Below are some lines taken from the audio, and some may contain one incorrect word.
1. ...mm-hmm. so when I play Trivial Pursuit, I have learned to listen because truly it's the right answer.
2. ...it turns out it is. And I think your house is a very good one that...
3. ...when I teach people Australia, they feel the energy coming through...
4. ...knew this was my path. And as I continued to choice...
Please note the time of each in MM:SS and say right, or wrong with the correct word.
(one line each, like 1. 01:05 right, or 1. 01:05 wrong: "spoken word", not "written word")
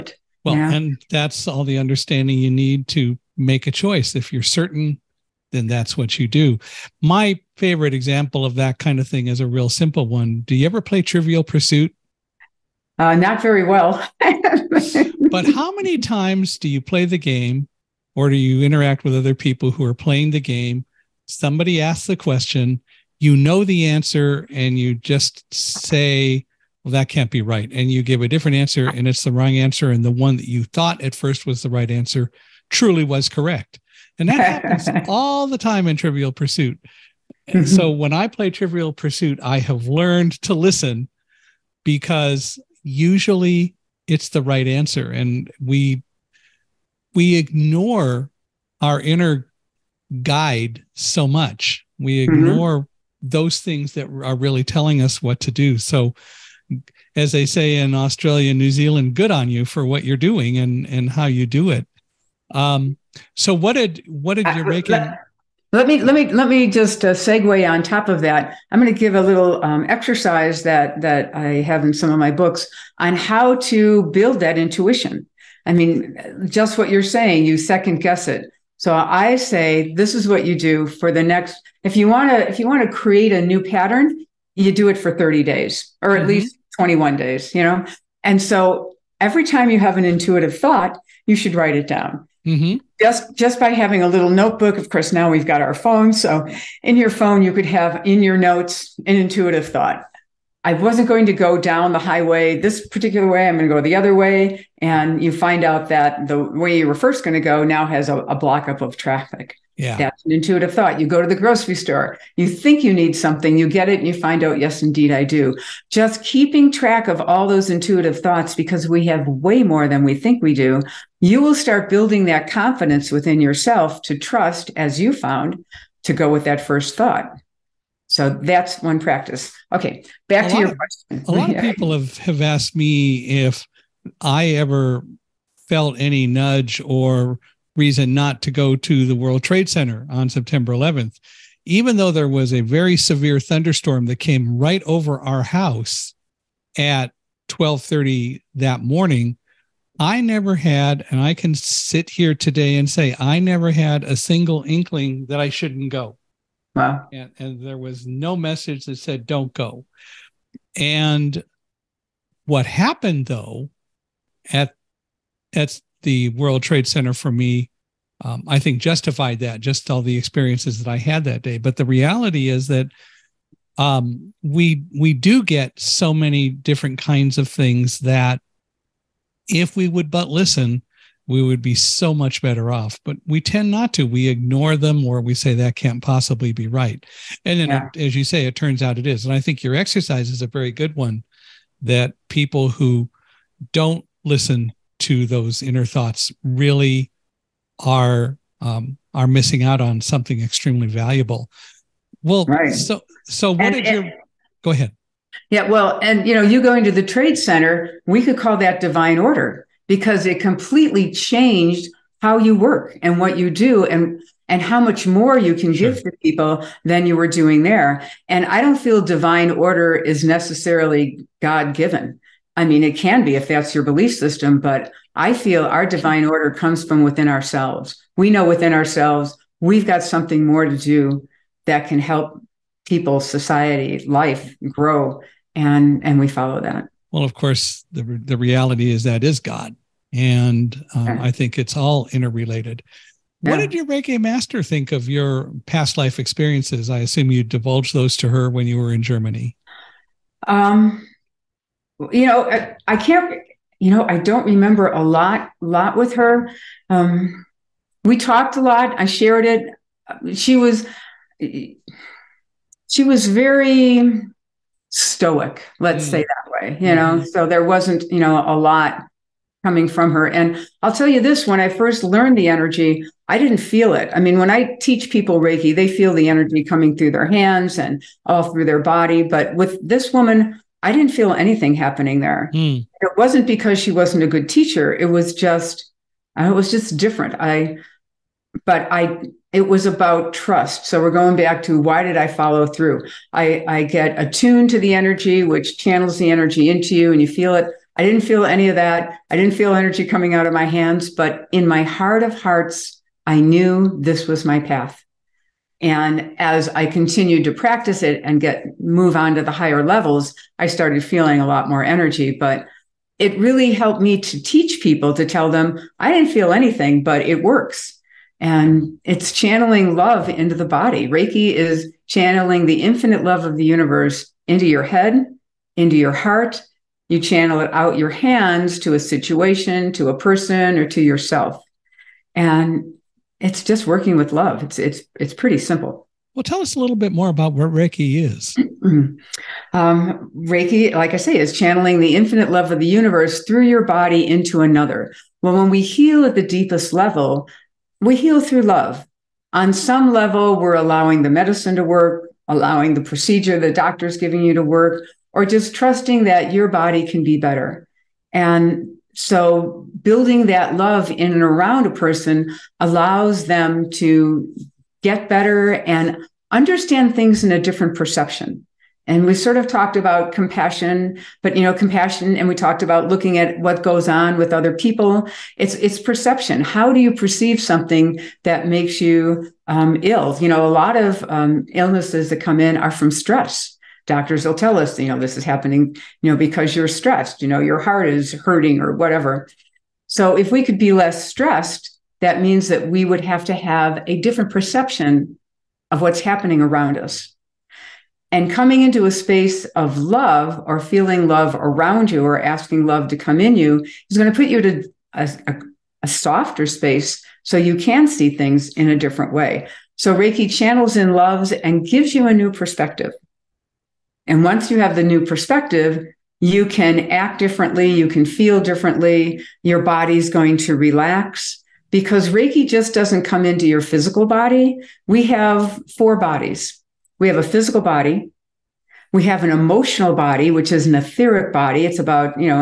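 1. 00:37 wrong: "usually", not "truly"
2. 03:08 wrong: "exercise", not "house"
3. 04:34 wrong: "Reiki", not "Australia"
4. 05:03 wrong: "practice", not "choice".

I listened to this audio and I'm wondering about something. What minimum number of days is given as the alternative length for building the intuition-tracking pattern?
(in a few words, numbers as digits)
21.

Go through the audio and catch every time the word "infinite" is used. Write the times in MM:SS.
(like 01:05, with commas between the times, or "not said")
05:22, 05:42.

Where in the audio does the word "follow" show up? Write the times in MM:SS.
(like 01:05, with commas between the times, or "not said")
03:56, 04:52.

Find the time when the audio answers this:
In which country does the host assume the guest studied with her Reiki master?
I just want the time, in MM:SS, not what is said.
04:09.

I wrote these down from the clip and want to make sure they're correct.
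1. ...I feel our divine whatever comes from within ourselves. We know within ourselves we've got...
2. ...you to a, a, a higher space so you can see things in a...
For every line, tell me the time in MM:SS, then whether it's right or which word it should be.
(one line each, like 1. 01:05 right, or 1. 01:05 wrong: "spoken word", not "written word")
1. 03:45 wrong: "order", not "whatever"
2. 06:44 wrong: "softer", not "higher".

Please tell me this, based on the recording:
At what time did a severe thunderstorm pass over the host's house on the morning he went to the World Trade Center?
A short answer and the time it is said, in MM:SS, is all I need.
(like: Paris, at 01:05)
12:30, at 02:27.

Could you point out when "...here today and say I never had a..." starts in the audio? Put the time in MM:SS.
02:32.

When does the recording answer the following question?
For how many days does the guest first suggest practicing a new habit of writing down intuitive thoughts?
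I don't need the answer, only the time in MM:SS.
01:25.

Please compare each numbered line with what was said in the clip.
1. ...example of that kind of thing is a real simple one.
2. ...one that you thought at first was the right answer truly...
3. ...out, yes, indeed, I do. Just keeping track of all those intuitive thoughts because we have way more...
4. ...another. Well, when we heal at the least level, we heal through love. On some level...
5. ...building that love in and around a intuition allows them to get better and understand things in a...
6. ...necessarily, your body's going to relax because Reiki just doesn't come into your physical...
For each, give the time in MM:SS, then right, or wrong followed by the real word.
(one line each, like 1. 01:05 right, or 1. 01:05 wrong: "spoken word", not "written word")
1. 00:07 right
2. 00:30 right
3. 01:54 right
4. 05:44 wrong: "deepest", not "least"
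5. 06:00 wrong: "person", not "intuition"
6. 06:58 wrong: "differently", not "necessarily".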